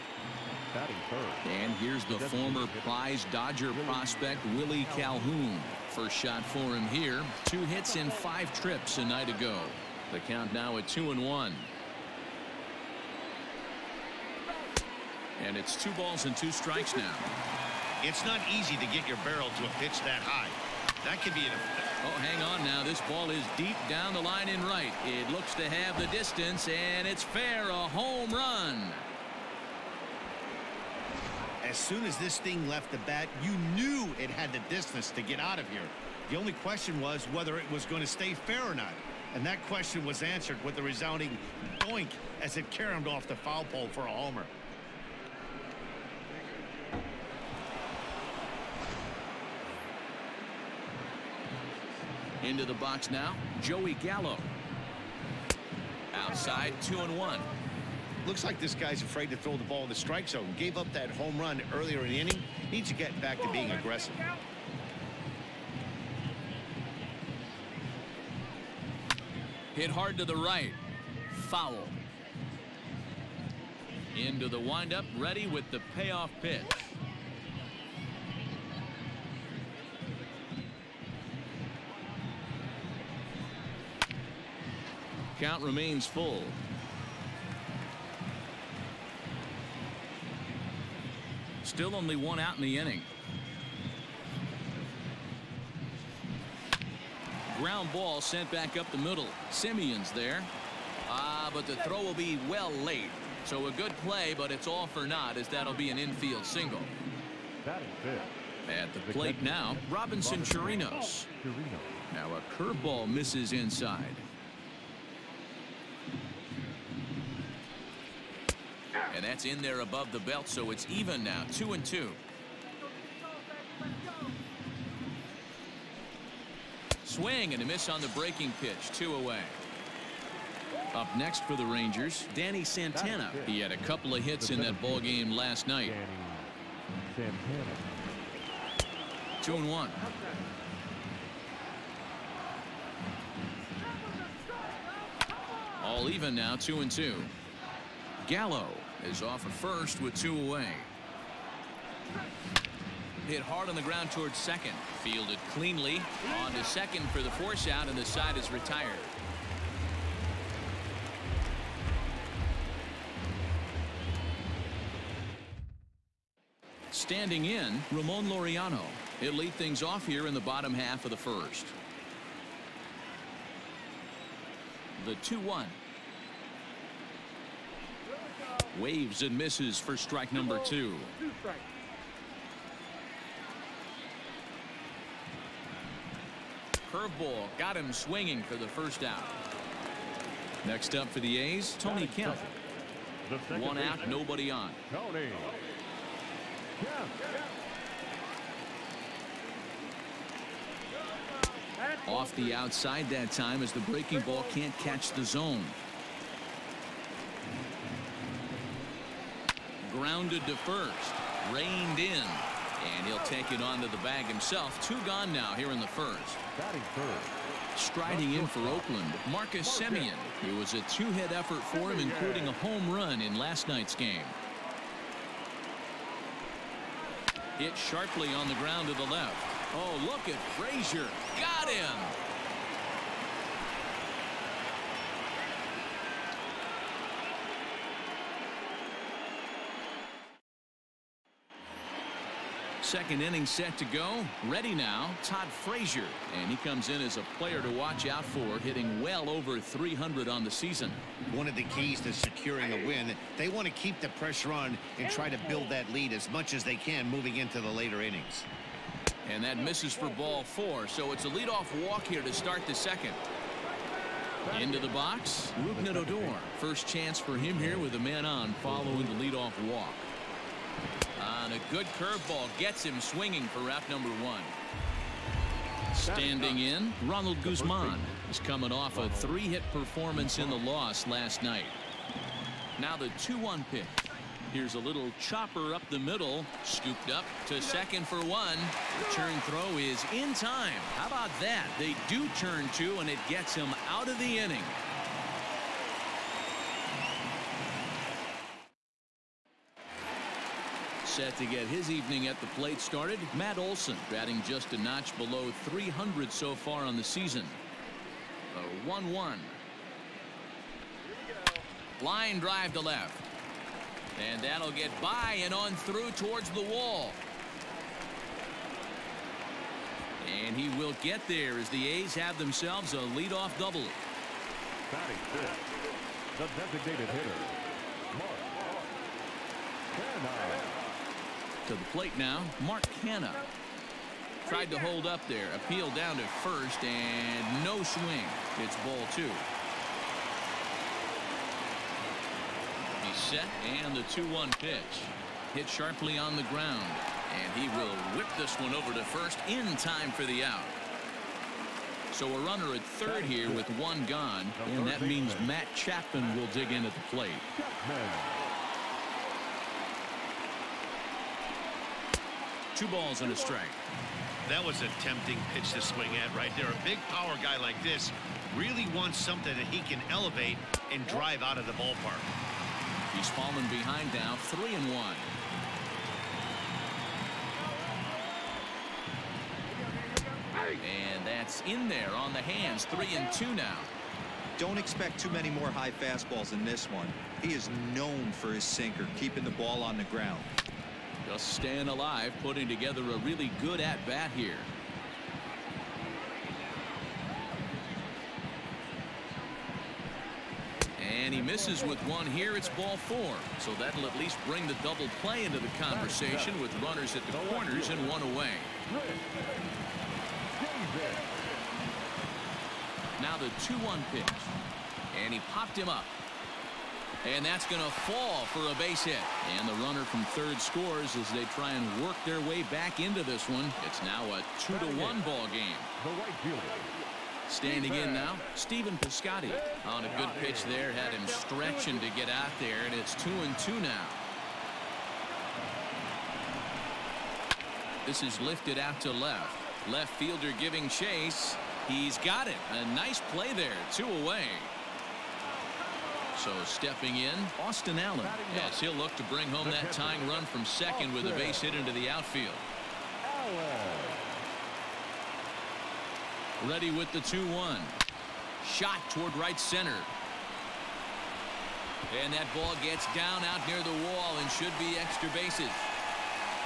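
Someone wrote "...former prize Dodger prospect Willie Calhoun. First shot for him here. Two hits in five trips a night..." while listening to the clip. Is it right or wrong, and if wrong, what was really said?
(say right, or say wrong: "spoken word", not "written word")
right.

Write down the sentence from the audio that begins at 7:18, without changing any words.
This is lifted out to left.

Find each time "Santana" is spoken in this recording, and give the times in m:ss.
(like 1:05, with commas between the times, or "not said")
2:12.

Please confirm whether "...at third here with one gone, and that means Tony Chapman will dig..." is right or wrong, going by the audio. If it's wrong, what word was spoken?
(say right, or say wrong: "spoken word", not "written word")
wrong: "Matt", not "Tony".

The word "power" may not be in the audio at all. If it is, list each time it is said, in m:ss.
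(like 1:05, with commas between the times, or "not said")
6:07.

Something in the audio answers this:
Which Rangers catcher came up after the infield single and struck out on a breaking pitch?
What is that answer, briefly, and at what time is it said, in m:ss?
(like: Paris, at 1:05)
Robinson Chirinos, at 1:49.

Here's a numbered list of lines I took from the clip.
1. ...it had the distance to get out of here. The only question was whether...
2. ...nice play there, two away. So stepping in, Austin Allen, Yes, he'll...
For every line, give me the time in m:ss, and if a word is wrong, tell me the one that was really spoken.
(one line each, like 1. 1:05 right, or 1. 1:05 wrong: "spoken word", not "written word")
1. 0:34 right
2. 7:22 right.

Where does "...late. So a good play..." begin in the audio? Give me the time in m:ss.
1:42.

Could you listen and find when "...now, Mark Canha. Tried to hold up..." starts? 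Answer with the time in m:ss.
5:32.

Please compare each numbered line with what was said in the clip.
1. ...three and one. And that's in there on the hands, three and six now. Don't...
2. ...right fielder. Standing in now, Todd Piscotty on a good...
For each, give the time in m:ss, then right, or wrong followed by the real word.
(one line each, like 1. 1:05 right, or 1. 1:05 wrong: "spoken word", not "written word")
1. 6:14 wrong: "two", not "six"
2. 7:06 wrong: "Stephen", not "Todd".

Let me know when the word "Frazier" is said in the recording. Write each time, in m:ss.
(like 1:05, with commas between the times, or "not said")
3:50, 4:05.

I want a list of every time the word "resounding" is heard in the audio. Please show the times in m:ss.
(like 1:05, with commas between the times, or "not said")
0:40.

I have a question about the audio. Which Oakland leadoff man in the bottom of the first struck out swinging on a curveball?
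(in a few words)
Ramon Laureano.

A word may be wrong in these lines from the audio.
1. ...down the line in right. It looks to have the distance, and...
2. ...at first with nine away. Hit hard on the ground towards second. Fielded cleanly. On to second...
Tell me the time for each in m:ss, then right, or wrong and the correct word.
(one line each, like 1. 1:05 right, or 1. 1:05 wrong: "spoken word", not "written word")
1. 0:23 right
2. 2:29 wrong: "two", not "nine".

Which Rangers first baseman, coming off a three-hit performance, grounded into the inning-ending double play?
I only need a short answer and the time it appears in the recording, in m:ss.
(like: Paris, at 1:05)
Ronald Guzman, at 4:37.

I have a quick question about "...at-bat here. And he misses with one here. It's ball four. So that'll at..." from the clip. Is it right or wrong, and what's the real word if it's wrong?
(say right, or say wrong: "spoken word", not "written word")
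right.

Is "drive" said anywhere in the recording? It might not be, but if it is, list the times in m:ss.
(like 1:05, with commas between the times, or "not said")
5:12, 6:11.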